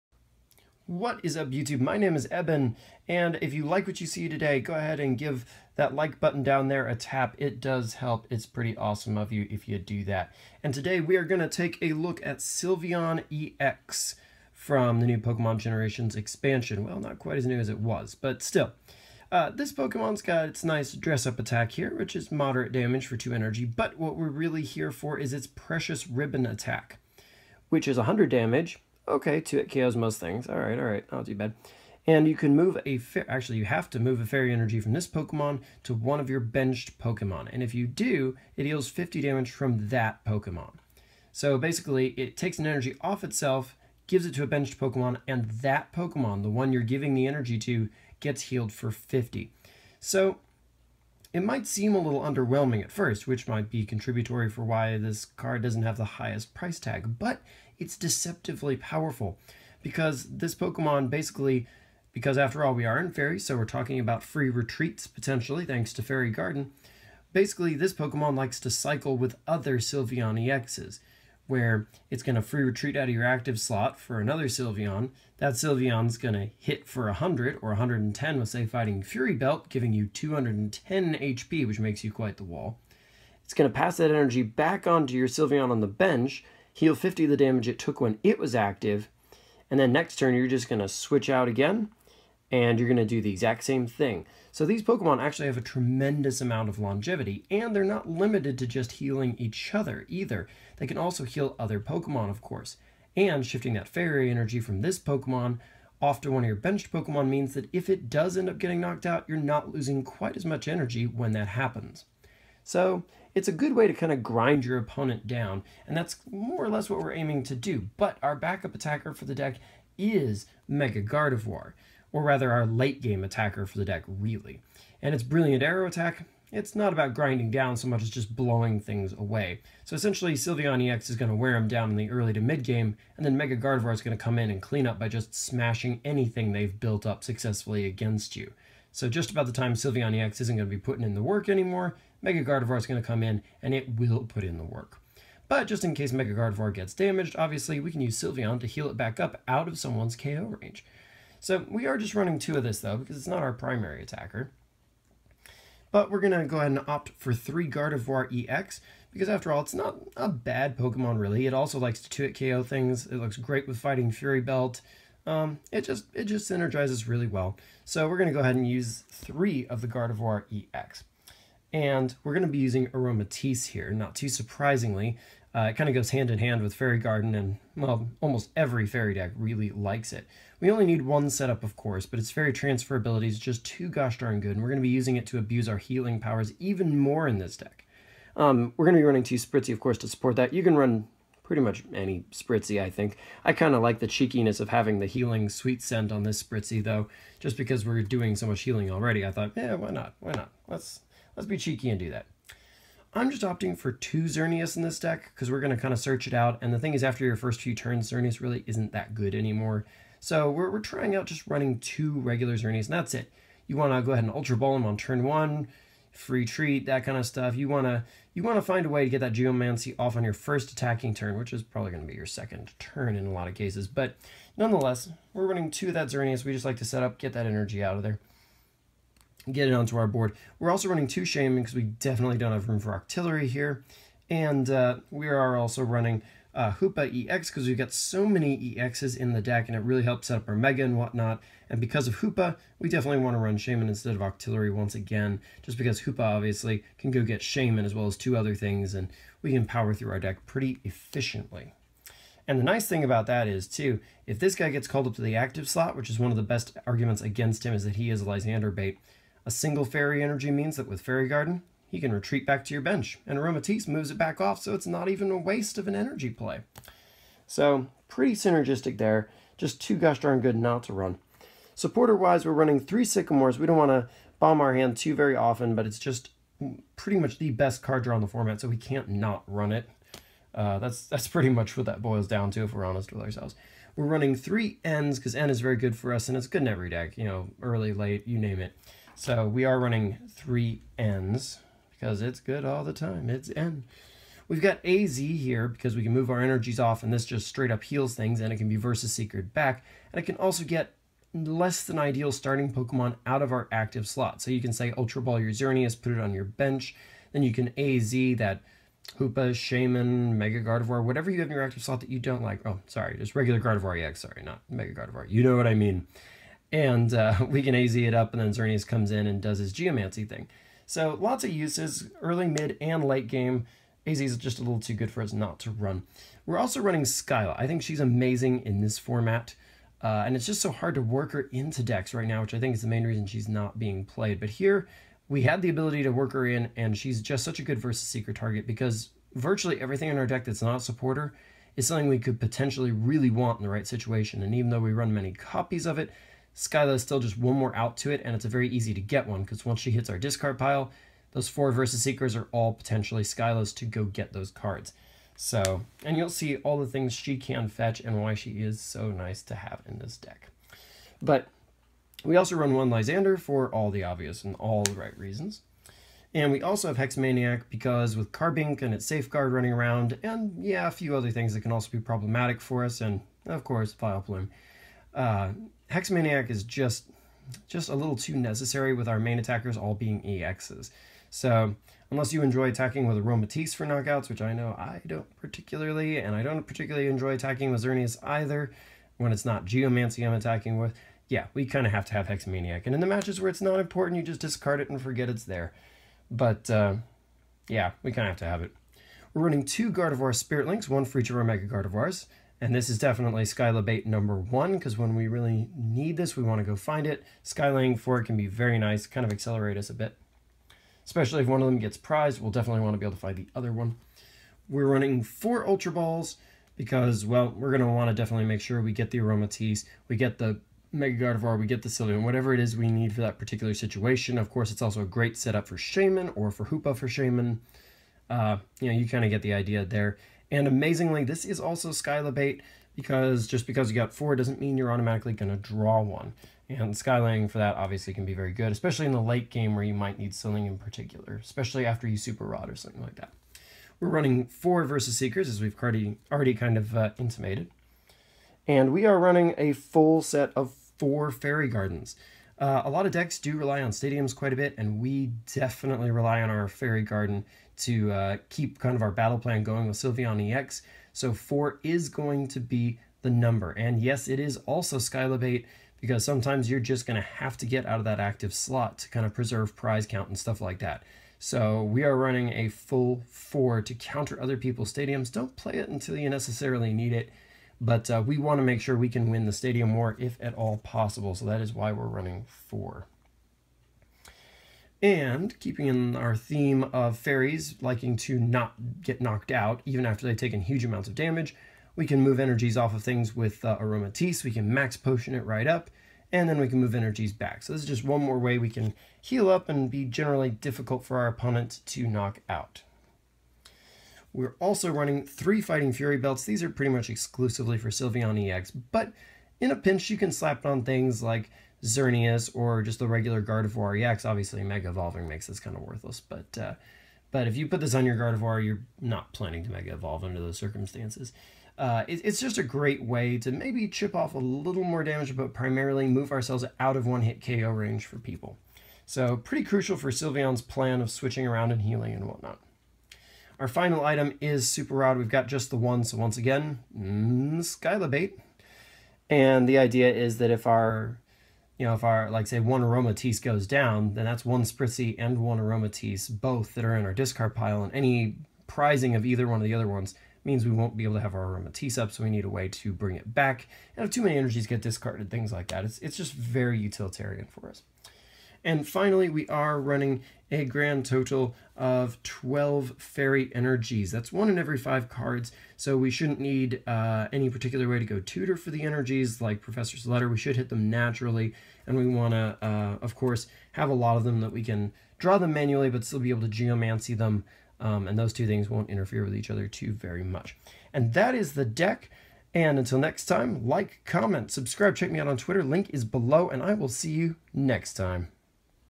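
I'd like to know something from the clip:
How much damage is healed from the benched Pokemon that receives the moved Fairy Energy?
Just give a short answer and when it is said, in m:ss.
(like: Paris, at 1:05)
50, at 0:38.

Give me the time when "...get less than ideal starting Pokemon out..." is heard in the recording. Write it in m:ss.
5:00.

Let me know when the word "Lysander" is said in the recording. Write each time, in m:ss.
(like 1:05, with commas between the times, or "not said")
4:18, 6:02.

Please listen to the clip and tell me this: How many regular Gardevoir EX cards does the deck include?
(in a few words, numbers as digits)
3.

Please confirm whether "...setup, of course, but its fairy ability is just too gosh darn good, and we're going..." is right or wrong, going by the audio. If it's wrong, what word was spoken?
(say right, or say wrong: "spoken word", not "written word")
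wrong: "transferability", not "ability".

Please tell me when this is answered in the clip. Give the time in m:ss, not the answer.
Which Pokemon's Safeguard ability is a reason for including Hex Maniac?
6:08.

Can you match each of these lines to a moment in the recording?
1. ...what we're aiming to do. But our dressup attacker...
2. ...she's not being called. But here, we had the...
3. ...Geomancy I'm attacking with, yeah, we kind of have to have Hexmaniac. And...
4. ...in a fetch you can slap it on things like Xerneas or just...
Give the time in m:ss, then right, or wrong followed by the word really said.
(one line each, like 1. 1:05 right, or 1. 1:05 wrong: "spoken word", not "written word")
1. 1:56 wrong: "backup", not "dressup"
2. 5:33 wrong: "played", not "called"
3. 6:29 right
4. 8:29 wrong: "pinch", not "fetch".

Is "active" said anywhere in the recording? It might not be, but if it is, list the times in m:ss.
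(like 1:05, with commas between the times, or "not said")
1:13, 1:28, 4:15, 5:03, 5:11, 7:48.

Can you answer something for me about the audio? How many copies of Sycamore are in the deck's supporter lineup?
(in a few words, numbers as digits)
3.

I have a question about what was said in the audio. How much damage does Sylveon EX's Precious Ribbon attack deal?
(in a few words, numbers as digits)
100.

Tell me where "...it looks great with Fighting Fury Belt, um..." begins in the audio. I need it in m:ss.
2:43.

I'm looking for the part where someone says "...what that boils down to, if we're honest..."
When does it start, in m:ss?
4:41.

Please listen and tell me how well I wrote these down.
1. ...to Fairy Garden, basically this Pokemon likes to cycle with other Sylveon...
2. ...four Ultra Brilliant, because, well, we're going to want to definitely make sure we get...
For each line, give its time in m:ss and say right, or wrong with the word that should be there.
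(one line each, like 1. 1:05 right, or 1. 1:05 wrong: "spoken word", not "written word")
1. 1:05 right
2. 6:55 wrong: "Balls", not "Brilliant".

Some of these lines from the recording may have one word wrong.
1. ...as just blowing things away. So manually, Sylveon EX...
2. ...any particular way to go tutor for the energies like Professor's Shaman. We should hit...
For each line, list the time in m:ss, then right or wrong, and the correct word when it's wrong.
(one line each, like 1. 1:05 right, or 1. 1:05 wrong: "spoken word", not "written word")
1. 2:08 wrong: "essentially", not "manually"
2. 9:27 wrong: "Letter", not "Shaman".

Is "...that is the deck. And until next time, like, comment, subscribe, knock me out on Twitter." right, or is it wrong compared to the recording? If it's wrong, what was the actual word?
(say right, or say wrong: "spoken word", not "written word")
wrong: "check", not "knock".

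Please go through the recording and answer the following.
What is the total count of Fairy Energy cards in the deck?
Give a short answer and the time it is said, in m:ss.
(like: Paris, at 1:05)
12, at 9:22.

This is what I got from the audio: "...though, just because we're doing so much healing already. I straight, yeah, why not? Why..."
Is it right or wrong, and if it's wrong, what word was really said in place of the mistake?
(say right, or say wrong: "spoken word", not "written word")
wrong: "thought", not "straight".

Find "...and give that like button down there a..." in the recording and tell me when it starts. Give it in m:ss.
0:04.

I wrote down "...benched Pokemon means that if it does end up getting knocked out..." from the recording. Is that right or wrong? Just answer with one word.
right.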